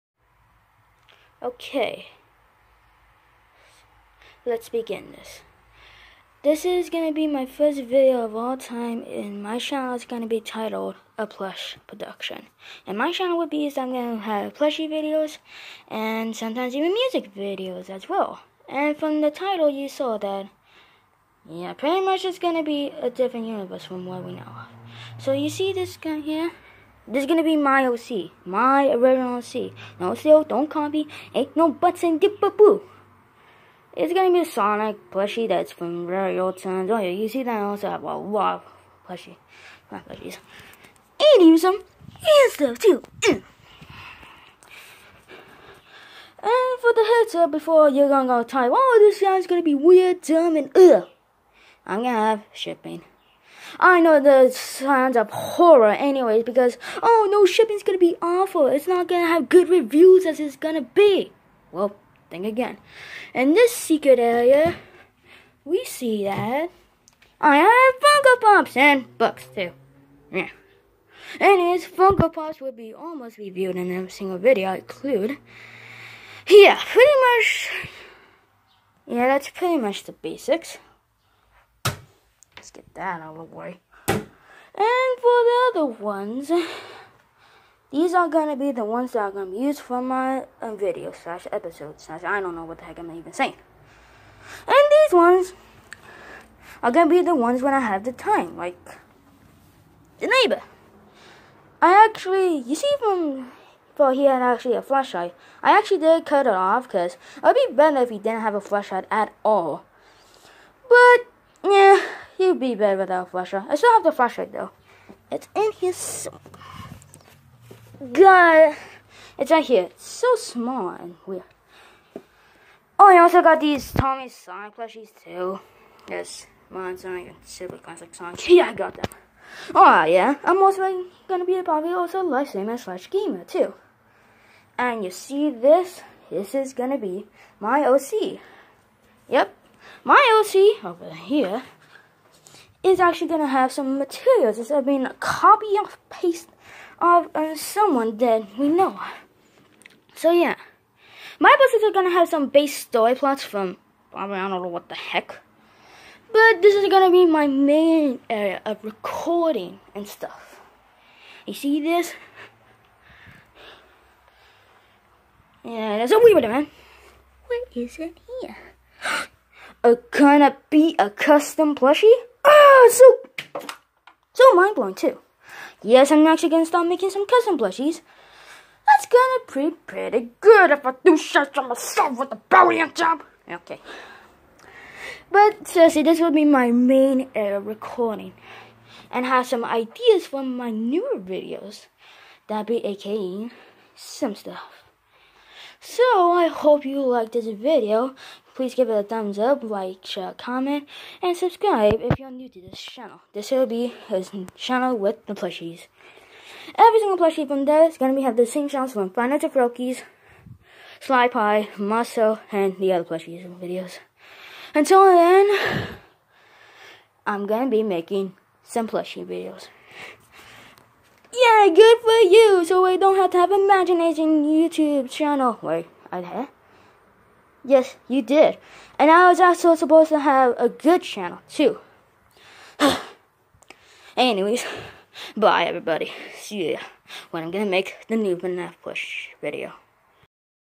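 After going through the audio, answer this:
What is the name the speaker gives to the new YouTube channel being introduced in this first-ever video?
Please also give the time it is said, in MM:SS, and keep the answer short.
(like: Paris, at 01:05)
A Plush Production, at 00:11.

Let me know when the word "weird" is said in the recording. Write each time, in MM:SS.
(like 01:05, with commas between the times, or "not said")
00:49, 02:01.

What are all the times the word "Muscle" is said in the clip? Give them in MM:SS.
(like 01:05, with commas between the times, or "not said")
03:31.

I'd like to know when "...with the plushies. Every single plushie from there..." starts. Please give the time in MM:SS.
03:24.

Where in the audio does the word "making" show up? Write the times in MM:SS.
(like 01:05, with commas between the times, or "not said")
02:56, 03:37.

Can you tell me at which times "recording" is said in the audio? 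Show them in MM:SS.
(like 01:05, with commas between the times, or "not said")
02:38, 03:07.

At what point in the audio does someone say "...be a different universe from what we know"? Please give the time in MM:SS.
00:22.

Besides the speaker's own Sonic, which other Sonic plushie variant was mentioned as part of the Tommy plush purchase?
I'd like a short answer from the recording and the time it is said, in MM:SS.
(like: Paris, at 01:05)
Super Classic Sonic, at 02:07.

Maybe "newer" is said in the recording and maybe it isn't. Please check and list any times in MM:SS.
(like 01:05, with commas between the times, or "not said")
03:10.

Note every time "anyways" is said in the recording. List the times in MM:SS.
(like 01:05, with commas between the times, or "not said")
00:55, 01:11, 03:54.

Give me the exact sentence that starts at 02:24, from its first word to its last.
It's I mean, a copy of paste of uh, someone that we know.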